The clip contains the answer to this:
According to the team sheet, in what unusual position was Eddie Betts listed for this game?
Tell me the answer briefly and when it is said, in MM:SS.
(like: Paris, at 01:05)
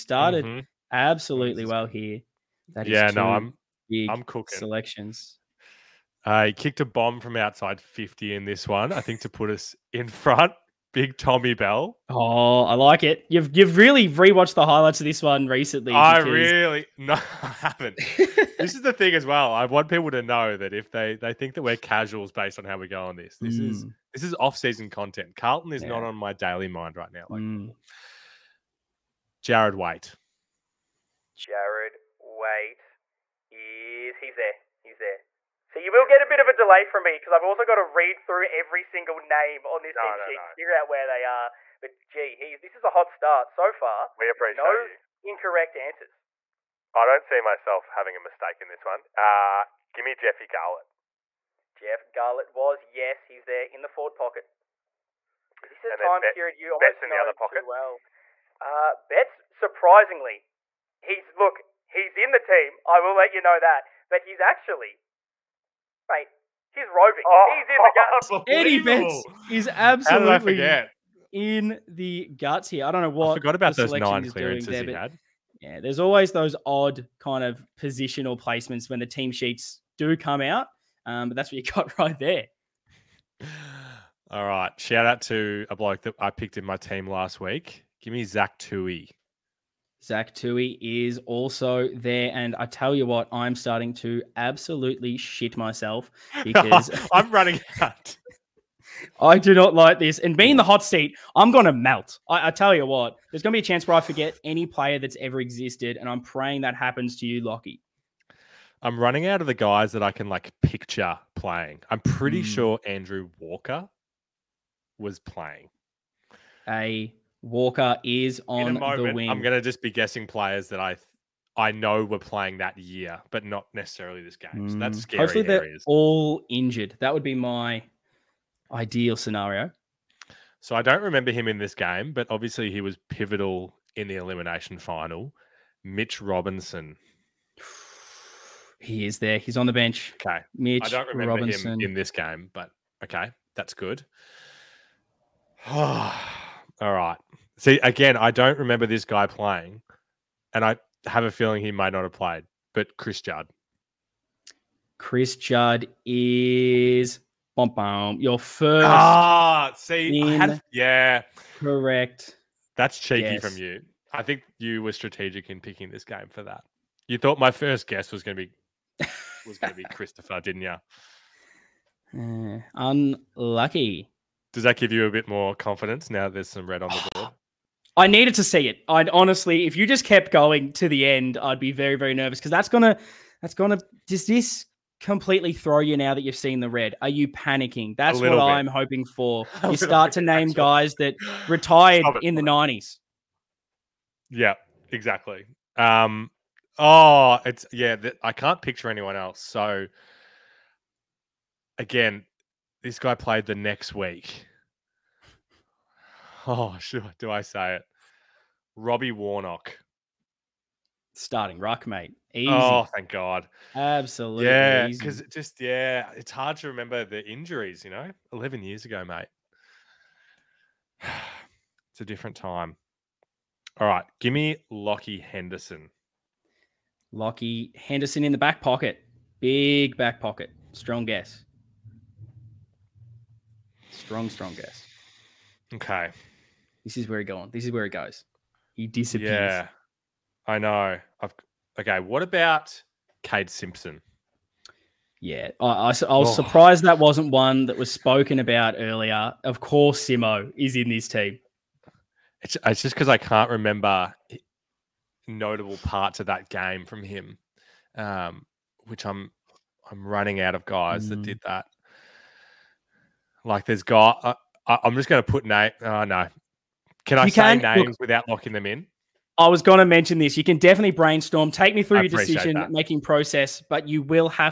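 Roving, at 01:06.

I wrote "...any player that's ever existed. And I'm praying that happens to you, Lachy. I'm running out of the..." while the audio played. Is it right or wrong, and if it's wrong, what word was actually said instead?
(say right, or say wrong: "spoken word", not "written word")
right.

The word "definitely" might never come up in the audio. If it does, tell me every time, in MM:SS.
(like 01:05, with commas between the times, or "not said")
04:30.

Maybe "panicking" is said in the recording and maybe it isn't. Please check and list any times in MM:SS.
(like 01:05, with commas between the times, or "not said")
03:07.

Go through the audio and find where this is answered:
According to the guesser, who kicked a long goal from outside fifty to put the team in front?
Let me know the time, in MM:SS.
00:10.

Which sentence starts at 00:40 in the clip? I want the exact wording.
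and figure out where they are.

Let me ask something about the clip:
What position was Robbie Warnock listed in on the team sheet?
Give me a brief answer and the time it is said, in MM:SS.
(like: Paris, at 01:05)
Starting rock, at 03:31.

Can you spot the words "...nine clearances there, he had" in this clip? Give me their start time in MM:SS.
01:13.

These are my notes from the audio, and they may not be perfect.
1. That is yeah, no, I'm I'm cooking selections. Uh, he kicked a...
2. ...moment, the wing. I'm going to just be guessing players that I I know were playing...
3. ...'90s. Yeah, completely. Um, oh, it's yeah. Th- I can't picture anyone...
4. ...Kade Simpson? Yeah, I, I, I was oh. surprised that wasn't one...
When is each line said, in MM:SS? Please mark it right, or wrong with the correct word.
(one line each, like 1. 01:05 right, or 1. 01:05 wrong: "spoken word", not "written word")
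1. 00:02 right
2. 01:58 right
3. 03:12 wrong: "exactly", not "completely"
4. 04:03 right.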